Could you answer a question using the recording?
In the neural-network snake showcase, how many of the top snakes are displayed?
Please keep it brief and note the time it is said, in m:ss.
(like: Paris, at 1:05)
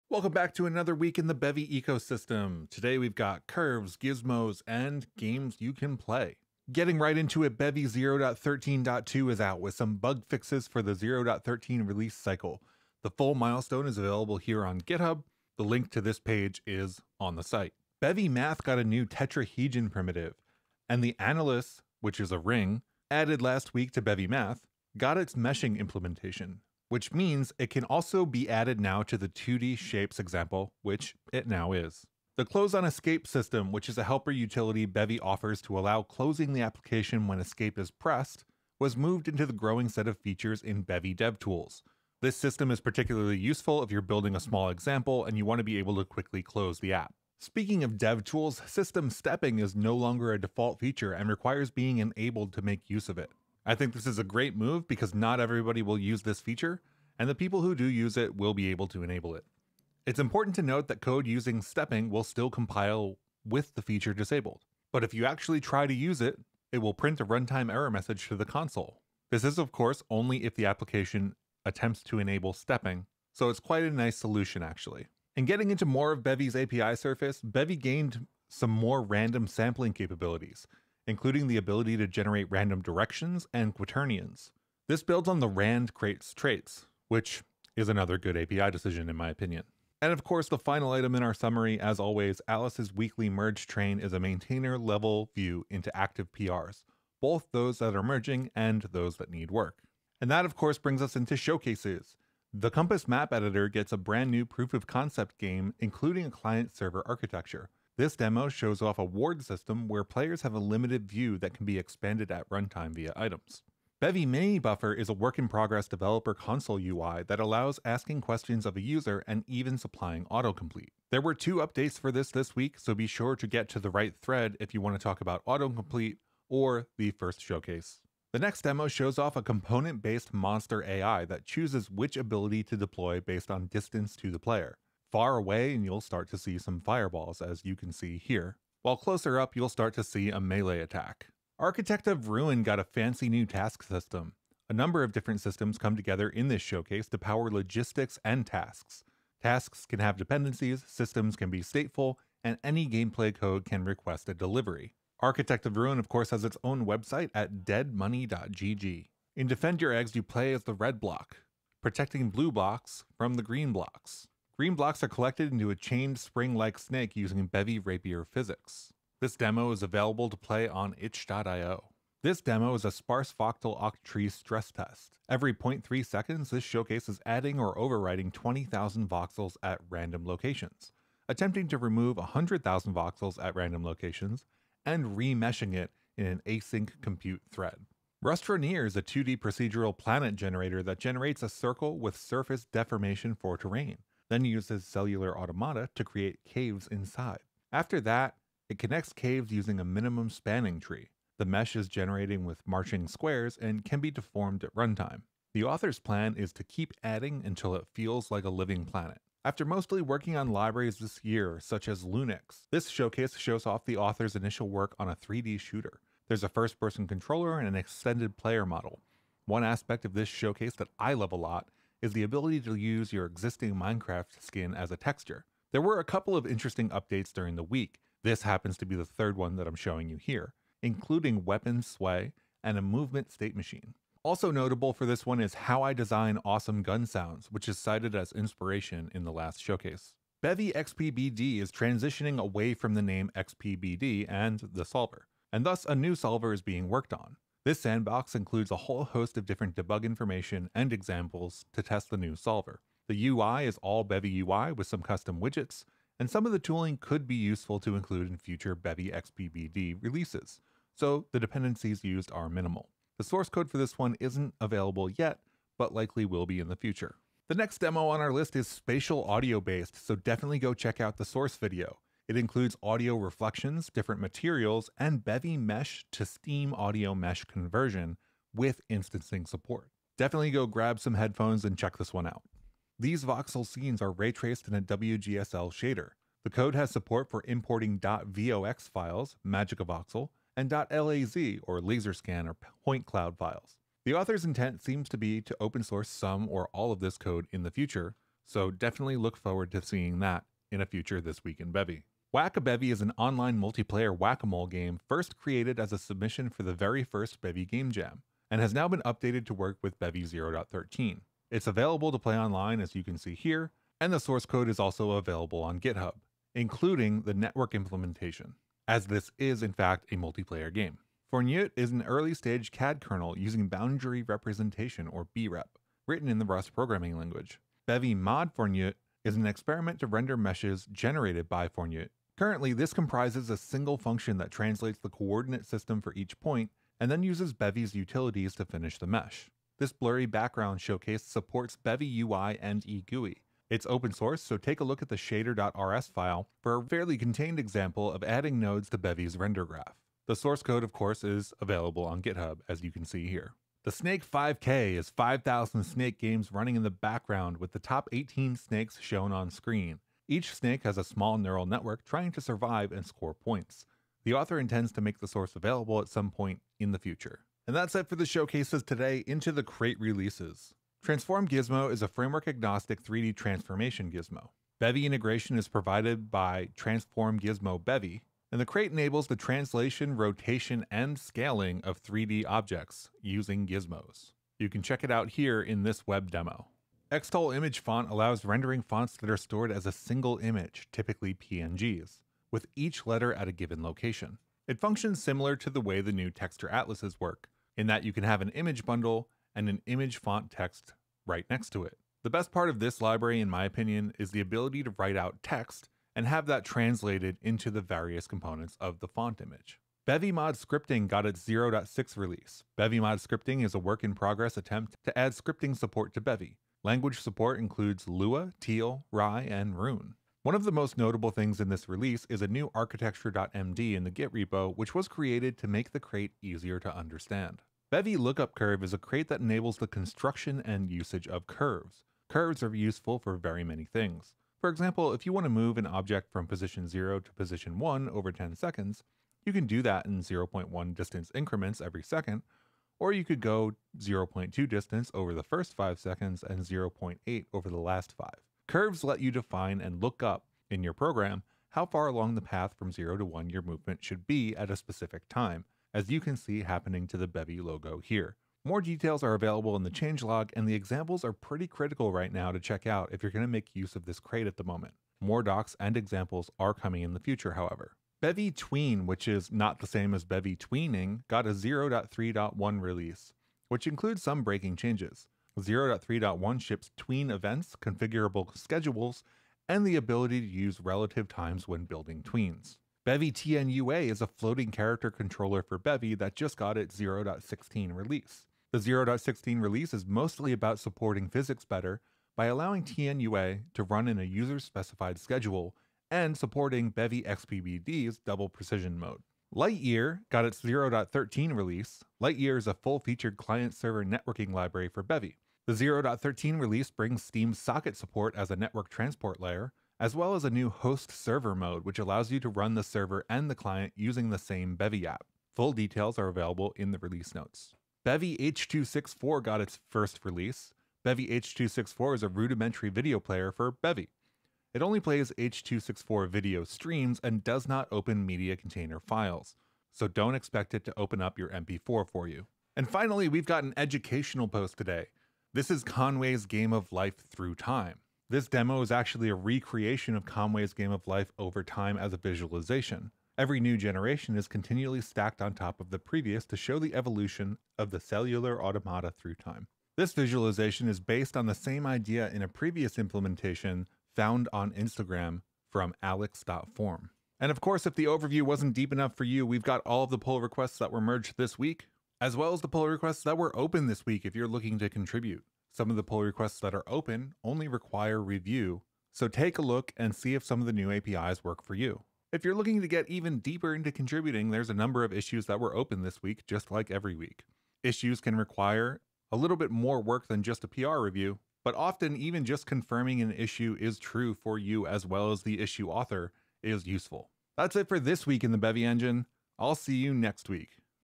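18, at 5:58.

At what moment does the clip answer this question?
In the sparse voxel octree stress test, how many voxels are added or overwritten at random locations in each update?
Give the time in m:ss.
2:58.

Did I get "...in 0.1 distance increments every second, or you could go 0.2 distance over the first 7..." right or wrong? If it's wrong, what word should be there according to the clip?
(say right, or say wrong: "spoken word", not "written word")
wrong: "5", not "7".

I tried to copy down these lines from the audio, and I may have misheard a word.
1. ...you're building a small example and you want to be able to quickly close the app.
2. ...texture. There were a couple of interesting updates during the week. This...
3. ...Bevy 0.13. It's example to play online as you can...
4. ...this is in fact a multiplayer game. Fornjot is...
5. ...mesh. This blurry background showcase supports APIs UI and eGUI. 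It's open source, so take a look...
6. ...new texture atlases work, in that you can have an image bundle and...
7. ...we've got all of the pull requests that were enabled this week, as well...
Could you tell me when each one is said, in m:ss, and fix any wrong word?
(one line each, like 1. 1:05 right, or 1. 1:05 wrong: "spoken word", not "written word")
1. 0:43 right
2. 3:44 right
3. 5:09 wrong: "available", not "example"
4. 5:19 right
5. 5:39 wrong: "Bevy", not "APIs"
6. 6:36 right
7. 9:19 wrong: "merged", not "enabled".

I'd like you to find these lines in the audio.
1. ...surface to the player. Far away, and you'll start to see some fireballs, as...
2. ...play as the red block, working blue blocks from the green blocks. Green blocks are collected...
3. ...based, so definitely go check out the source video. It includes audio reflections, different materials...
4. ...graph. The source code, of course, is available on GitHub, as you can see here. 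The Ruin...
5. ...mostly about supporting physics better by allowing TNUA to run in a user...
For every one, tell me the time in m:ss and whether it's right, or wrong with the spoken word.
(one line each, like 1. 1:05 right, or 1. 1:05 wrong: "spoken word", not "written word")
1. 2:13 wrong: "distance", not "surface"
2. 2:40 wrong: "protecting", not "working"
3. 4:29 right
4. 5:49 wrong: "Snake", not "Ruin"
5. 8:10 right.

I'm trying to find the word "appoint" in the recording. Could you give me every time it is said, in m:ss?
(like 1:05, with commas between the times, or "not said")
not said.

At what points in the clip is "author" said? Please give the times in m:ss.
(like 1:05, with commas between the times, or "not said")
3:25, 3:33, 4:54, 6:04, 9:45.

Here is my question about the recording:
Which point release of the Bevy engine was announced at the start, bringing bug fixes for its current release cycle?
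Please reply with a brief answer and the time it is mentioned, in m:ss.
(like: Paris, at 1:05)
0.13.2, at 0:07.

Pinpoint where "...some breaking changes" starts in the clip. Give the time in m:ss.
7:54.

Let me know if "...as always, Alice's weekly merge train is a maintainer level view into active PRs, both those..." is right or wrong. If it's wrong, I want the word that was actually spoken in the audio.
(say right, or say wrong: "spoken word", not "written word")
right.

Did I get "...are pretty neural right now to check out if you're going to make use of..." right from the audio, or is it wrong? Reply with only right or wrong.
wrong.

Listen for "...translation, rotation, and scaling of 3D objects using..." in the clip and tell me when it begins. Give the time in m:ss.
6:19.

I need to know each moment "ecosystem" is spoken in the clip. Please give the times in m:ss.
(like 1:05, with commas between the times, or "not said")
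0:01.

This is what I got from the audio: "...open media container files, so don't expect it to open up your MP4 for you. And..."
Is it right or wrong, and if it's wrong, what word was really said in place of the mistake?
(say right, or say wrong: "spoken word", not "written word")
right.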